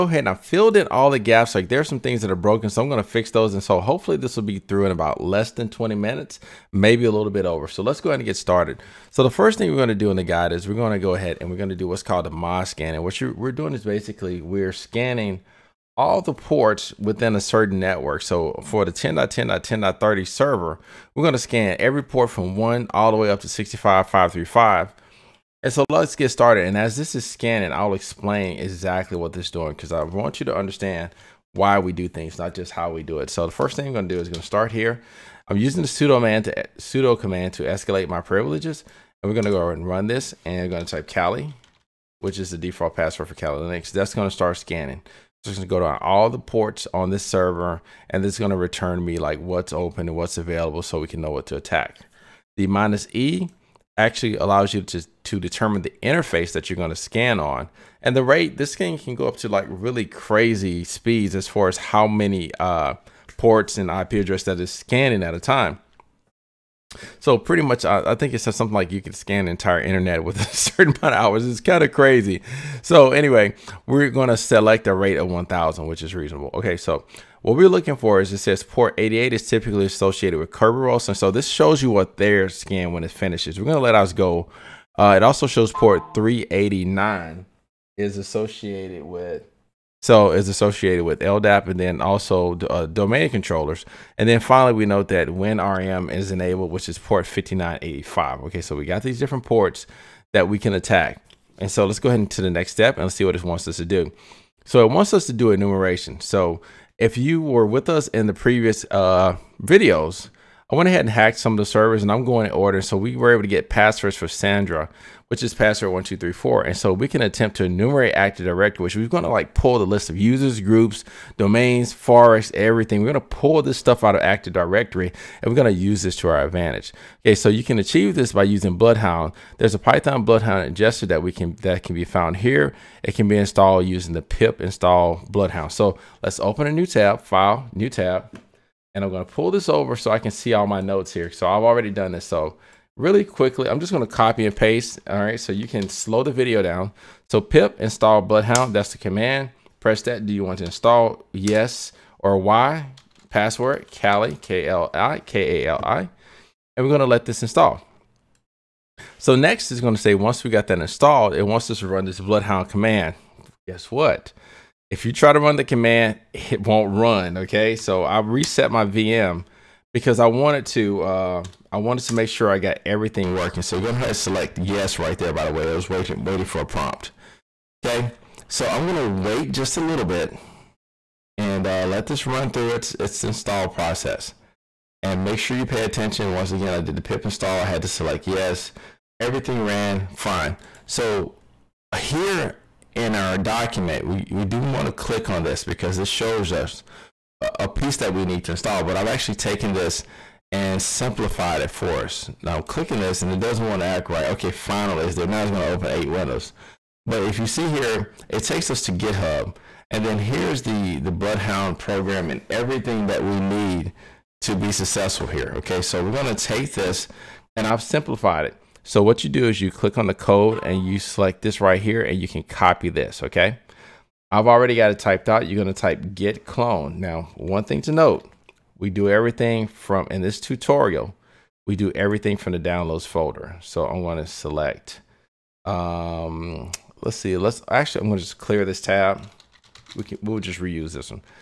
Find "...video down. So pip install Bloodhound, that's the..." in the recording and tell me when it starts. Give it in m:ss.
2:26.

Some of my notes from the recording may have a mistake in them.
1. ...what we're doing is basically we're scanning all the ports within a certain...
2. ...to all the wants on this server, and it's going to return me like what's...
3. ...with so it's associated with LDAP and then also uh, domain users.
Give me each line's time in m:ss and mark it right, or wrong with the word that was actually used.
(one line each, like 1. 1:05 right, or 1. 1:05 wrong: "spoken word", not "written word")
1. 0:13 right
2. 0:45 wrong: "ports", not "wants"
3. 1:29 wrong: "controllers", not "users".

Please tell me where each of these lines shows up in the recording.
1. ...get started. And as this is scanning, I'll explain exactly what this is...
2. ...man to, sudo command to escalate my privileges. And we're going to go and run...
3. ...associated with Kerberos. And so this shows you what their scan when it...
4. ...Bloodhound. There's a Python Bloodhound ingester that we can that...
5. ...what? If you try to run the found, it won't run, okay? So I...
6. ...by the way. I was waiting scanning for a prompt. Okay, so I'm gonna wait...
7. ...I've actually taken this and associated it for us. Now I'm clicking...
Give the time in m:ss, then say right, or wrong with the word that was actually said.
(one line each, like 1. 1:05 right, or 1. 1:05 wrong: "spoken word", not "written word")
1. 0:26 right
2. 0:36 right
3. 1:19 right
4. 2:08 right
5. 2:43 wrong: "command", not "found"
6. 2:55 wrong: "waiting", not "scanning"
7. 3:18 wrong: "simplified", not "associated".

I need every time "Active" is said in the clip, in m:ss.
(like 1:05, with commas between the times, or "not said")
1:58, 2:04.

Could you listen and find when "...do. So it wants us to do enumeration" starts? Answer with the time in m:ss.
1:43.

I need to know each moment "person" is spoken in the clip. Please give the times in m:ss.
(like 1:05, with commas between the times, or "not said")
not said.